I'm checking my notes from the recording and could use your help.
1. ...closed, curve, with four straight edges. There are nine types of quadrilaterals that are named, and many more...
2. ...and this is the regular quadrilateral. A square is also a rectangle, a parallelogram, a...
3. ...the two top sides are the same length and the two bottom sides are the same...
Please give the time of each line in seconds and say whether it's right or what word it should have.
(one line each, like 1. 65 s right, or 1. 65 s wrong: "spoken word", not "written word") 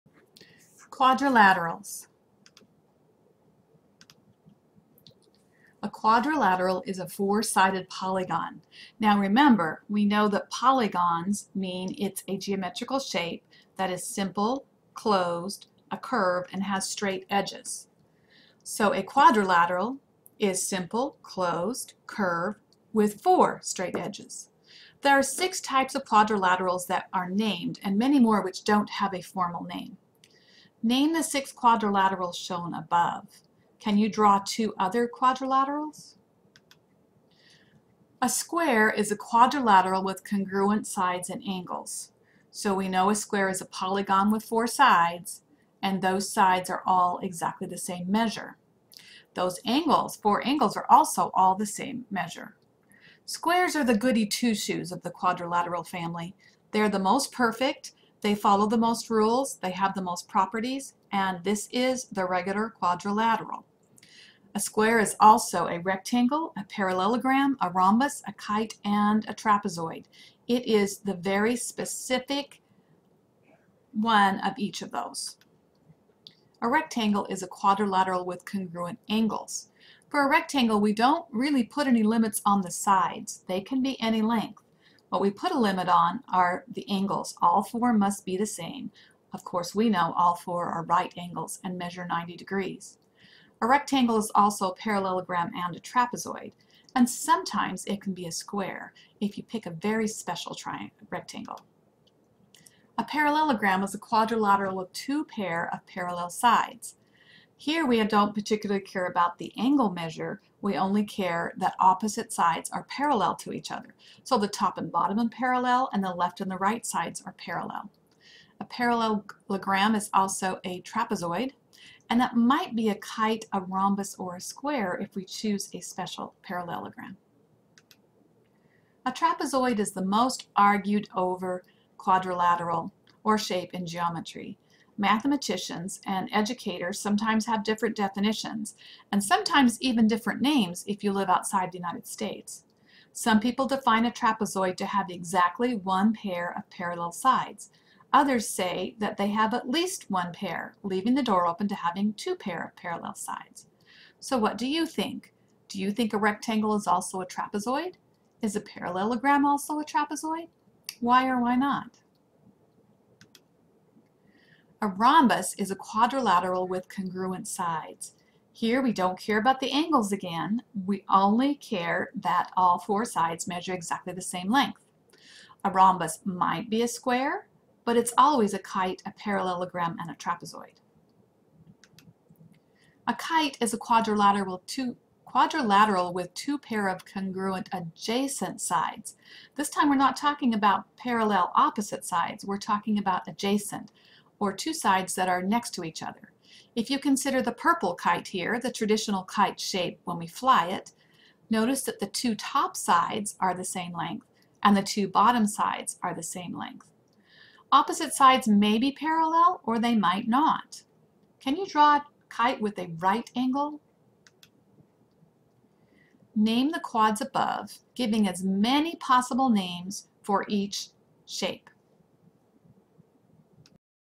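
1. 21 s wrong: "six", not "nine"
2. 61 s right
3. 201 s right.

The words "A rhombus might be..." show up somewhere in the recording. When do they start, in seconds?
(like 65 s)
175 s.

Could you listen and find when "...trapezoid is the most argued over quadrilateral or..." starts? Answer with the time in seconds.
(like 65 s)
129 s.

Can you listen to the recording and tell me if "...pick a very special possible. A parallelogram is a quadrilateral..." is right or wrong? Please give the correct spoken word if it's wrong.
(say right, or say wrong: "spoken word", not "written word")
wrong: "rectangle", not "possible".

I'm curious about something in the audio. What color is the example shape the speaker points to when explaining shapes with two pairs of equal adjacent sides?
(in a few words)
purple.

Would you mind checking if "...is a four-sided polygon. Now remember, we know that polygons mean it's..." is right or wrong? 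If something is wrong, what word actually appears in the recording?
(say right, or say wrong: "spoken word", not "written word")
right.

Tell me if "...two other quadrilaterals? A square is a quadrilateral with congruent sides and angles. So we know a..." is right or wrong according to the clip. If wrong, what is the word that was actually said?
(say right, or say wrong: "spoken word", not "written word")
right.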